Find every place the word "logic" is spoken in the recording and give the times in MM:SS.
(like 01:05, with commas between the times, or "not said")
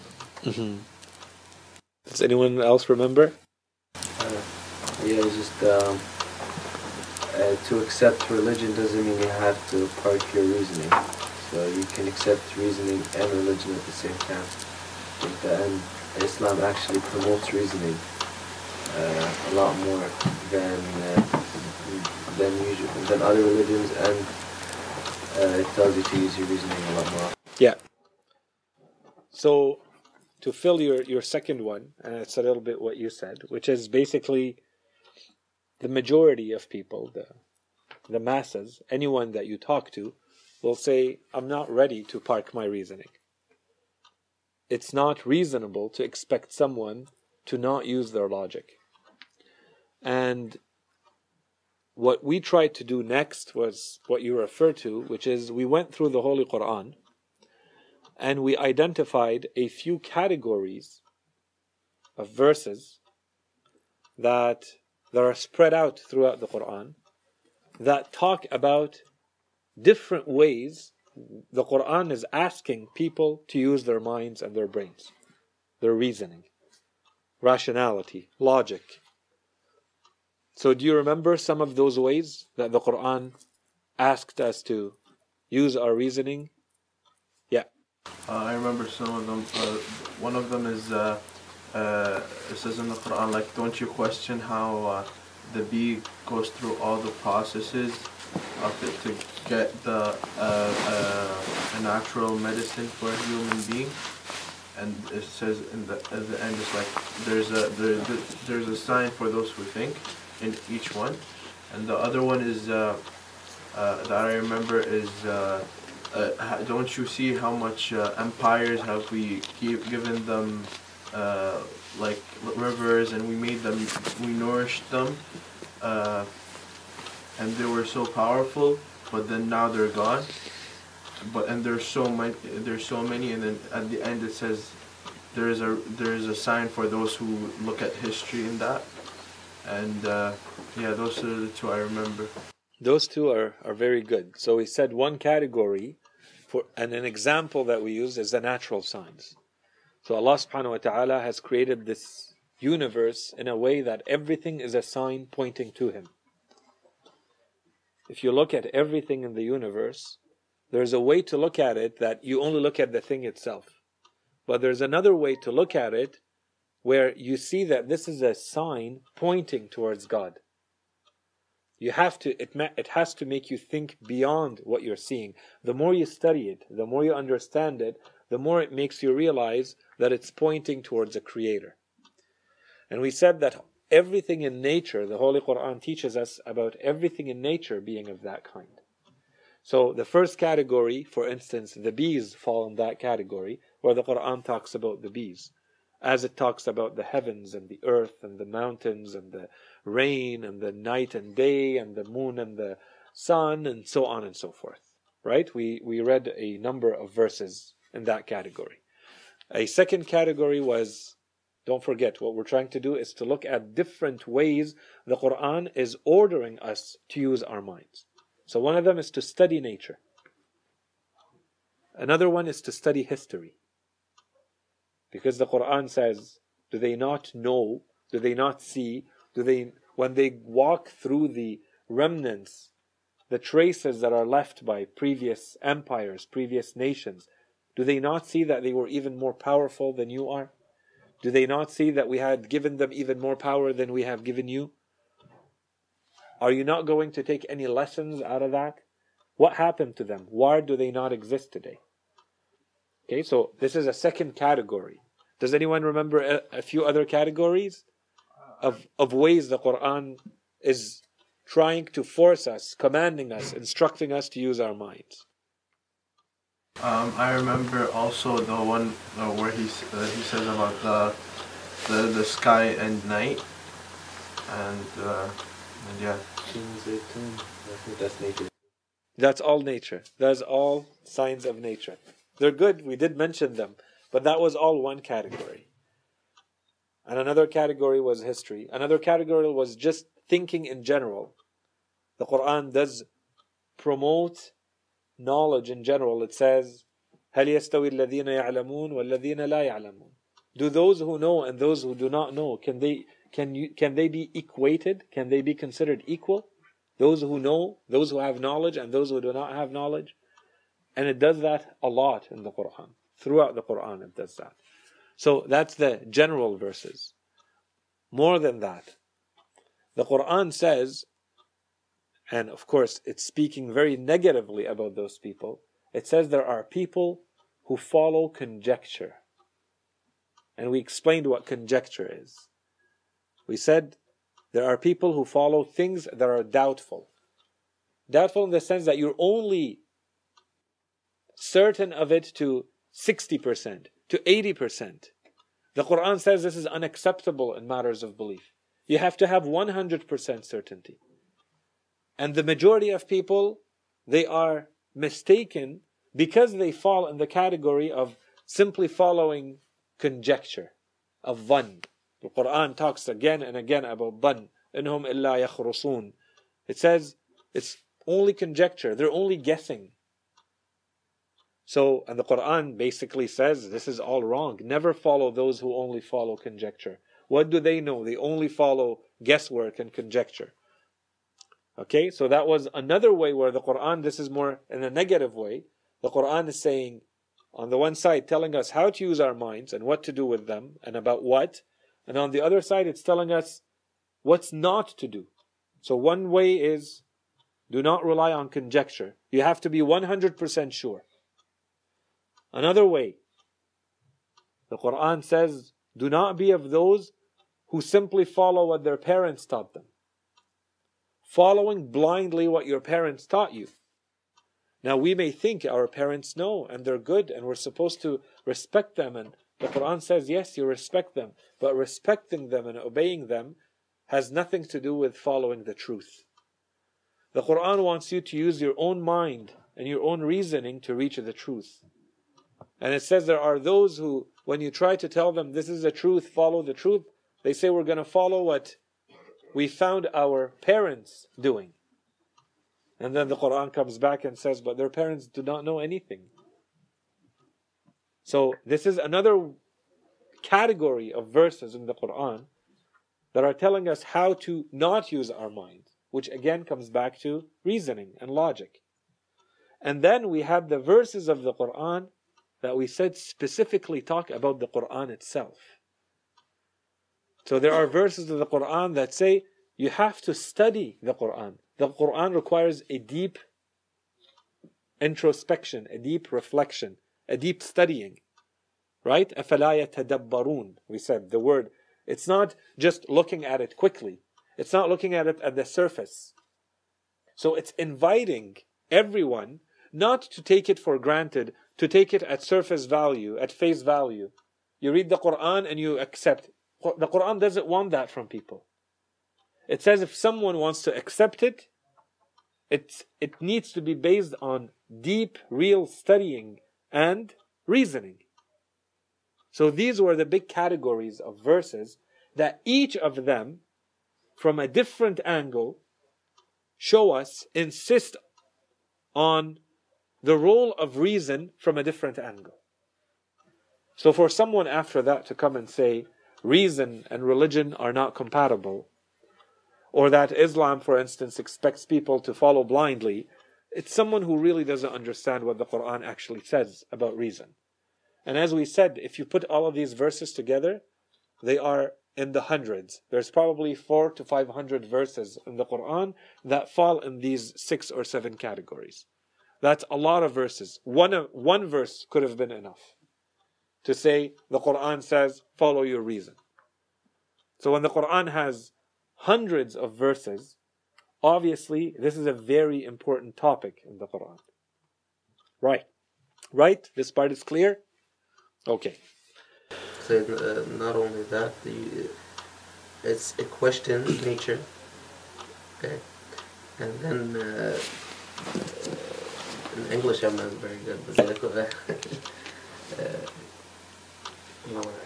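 00:48, 01:18, 07:38.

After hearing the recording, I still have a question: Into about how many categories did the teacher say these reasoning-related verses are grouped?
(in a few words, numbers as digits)
Six or seven.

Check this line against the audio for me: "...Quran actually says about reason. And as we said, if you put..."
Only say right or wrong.
right.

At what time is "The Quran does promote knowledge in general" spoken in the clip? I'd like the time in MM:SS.
04:52.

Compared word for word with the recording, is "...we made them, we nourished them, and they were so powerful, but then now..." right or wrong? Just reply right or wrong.
right.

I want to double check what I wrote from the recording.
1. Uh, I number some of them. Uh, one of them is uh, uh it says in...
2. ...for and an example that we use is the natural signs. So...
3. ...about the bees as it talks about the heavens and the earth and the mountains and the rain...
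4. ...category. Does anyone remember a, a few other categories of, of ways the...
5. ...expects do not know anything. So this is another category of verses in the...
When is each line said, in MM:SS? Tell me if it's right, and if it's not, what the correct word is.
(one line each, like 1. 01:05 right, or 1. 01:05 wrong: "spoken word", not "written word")
1. 01:28 wrong: "remember", not "number"
2. 02:26 right
3. 03:14 right
4. 04:14 right
5. 07:24 wrong: "parents", not "expects".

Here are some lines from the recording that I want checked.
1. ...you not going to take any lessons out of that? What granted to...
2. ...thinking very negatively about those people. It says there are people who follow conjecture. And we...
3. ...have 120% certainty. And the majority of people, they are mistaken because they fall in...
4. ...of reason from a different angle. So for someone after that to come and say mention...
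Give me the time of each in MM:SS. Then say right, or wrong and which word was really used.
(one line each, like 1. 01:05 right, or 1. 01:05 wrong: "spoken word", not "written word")
1. 04:06 wrong: "happened", not "granted"
2. 05:23 wrong: "speaking", not "thinking"
3. 05:49 wrong: "100", not "120"
4. 08:40 wrong: "reason", not "mention".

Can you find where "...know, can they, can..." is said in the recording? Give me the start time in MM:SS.
05:02.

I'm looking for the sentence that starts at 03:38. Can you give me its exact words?
So one of them is to study nature.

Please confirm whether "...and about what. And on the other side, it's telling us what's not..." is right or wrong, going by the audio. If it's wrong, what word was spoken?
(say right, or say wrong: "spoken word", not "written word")
right.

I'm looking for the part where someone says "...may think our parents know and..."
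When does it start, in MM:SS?
06:55.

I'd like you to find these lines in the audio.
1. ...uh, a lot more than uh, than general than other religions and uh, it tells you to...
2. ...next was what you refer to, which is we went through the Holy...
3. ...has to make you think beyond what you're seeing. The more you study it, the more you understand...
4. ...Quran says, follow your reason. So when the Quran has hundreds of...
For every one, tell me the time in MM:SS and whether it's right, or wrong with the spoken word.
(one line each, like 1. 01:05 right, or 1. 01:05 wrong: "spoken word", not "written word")
1. 00:18 wrong: "usual", not "general"
2. 00:53 right
3. 02:52 right
4. 09:14 right.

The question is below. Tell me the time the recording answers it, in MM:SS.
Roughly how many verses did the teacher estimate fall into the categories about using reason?
09:03.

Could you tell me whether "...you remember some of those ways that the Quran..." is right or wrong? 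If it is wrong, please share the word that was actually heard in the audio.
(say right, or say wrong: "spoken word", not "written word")
right.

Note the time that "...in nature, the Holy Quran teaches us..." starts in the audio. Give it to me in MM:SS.
03:04.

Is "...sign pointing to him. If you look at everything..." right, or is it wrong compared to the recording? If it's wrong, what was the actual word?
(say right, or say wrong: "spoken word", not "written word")
right.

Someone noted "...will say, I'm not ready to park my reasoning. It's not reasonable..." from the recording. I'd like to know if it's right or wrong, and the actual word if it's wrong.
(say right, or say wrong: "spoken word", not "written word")
right.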